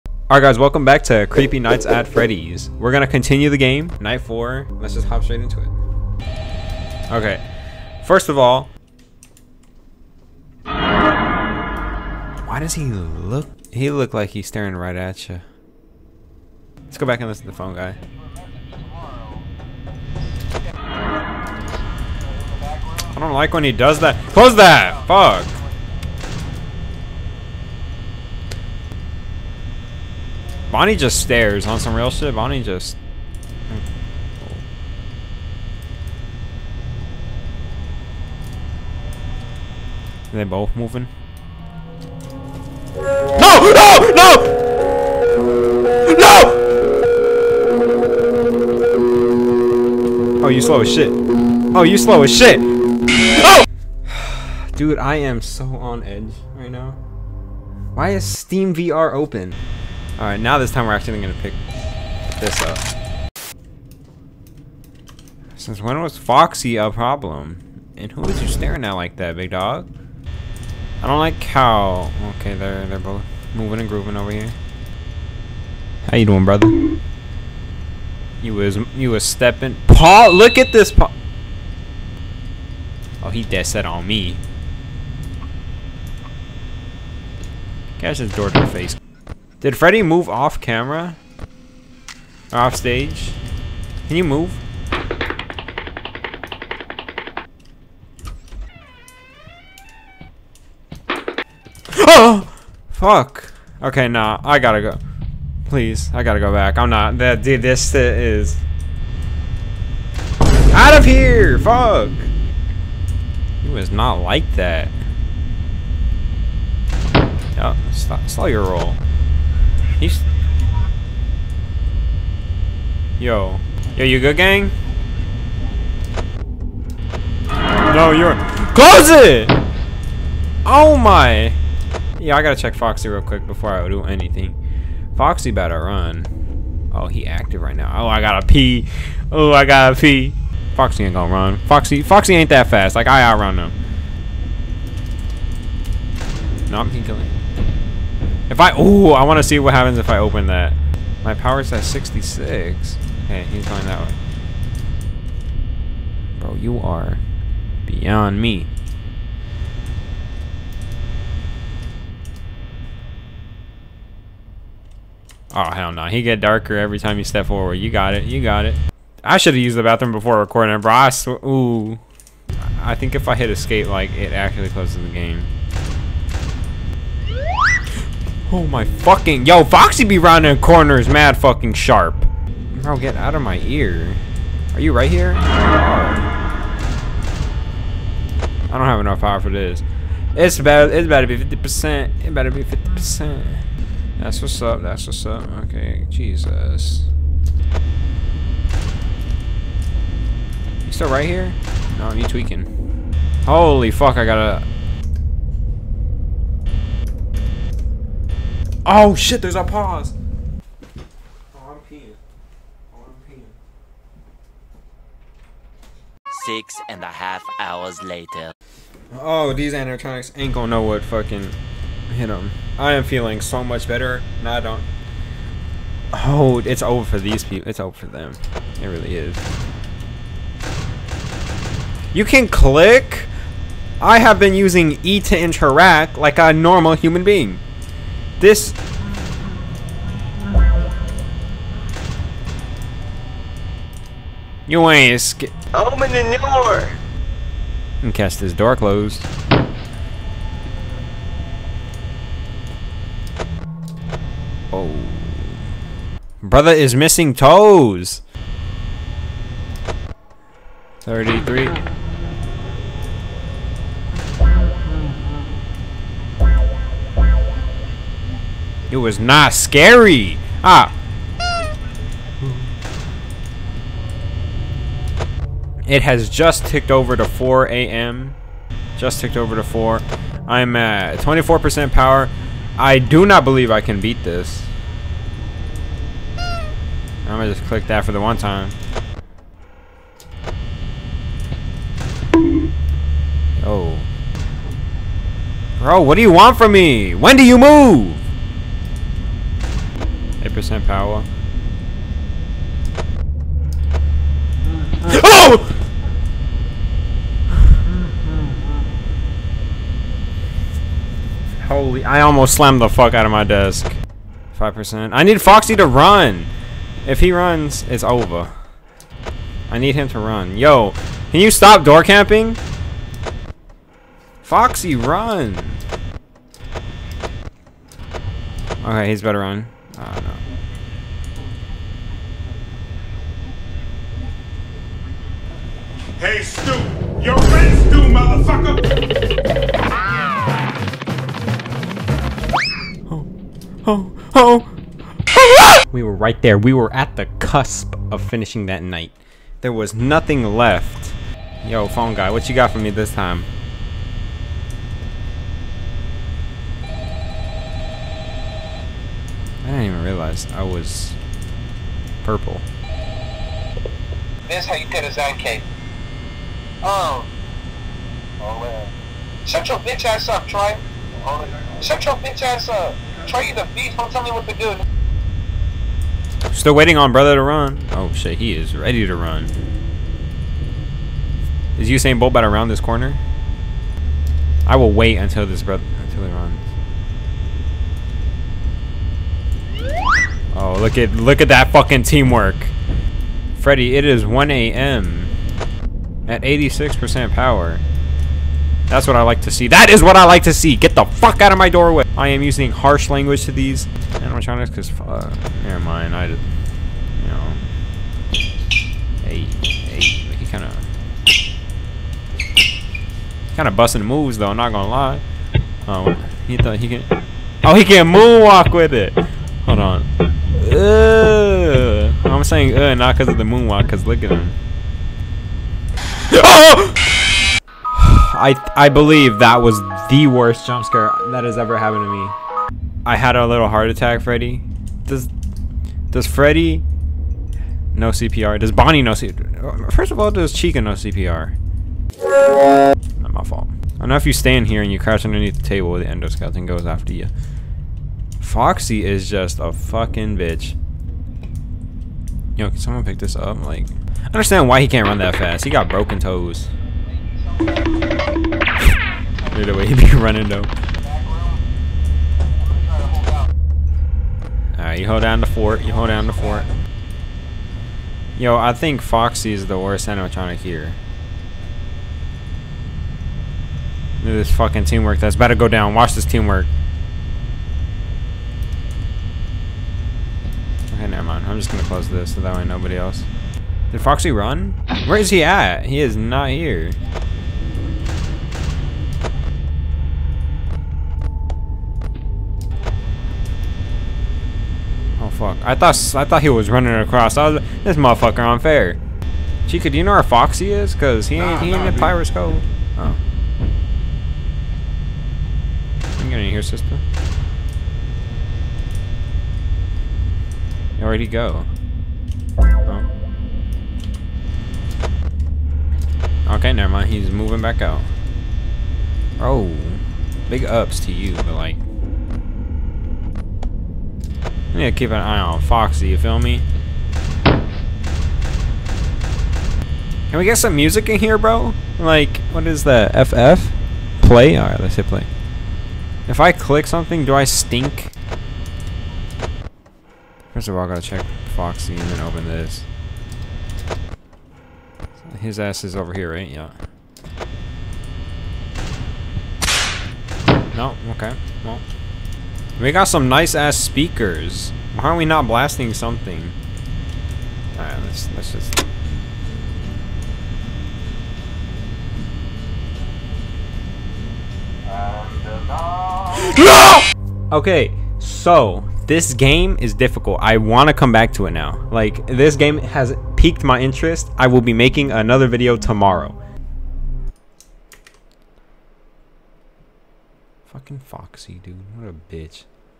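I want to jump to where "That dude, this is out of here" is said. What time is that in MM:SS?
01:47.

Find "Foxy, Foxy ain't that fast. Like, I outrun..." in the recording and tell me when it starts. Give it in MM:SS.
02:21.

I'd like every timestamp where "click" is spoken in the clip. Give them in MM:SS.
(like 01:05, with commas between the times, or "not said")
03:52, 04:47, 08:56.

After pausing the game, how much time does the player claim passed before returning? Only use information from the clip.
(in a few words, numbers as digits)
6 and a half hours.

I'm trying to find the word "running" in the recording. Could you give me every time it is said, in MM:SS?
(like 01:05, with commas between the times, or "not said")
07:40, 08:16.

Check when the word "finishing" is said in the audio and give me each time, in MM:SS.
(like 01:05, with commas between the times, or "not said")
05:48.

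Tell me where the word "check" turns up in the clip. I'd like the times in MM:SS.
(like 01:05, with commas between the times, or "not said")
02:12, 09:01.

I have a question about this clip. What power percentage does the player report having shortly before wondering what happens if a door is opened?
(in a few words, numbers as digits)
66.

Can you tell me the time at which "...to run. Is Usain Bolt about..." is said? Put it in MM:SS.
06:19.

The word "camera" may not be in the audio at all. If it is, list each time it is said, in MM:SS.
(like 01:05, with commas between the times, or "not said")
01:30.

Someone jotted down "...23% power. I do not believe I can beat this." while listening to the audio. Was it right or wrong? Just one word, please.
wrong.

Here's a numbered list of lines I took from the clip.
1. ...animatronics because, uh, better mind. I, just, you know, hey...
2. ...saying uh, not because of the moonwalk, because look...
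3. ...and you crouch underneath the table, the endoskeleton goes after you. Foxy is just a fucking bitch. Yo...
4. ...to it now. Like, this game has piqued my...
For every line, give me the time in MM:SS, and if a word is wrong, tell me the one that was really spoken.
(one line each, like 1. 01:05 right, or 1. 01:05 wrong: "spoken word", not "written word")
1. 06:44 wrong: "never", not "better"
2. 07:02 right
3. 07:24 right
4. 09:31 right.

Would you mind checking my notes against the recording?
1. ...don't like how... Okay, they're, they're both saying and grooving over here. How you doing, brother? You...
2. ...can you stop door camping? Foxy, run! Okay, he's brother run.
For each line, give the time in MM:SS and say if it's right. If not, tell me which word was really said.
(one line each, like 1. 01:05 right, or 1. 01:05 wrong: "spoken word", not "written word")
1. 01:11 wrong: "moving", not "saying"
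2. 05:21 wrong: "better", not "brother".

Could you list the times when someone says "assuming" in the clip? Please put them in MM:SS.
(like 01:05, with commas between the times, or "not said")
not said.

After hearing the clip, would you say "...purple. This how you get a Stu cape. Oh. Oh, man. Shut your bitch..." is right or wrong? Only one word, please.
wrong.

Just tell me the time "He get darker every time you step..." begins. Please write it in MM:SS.
02:46.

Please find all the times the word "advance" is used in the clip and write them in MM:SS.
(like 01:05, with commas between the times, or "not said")
not said.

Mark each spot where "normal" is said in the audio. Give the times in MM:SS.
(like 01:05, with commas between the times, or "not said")
03:56.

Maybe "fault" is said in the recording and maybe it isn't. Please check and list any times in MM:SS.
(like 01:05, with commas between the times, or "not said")
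07:23.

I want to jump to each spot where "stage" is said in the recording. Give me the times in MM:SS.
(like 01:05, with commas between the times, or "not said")
01:32.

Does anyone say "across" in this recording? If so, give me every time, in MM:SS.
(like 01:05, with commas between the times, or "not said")
08:16.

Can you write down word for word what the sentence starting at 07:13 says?
I had a little heart attack, Freddy.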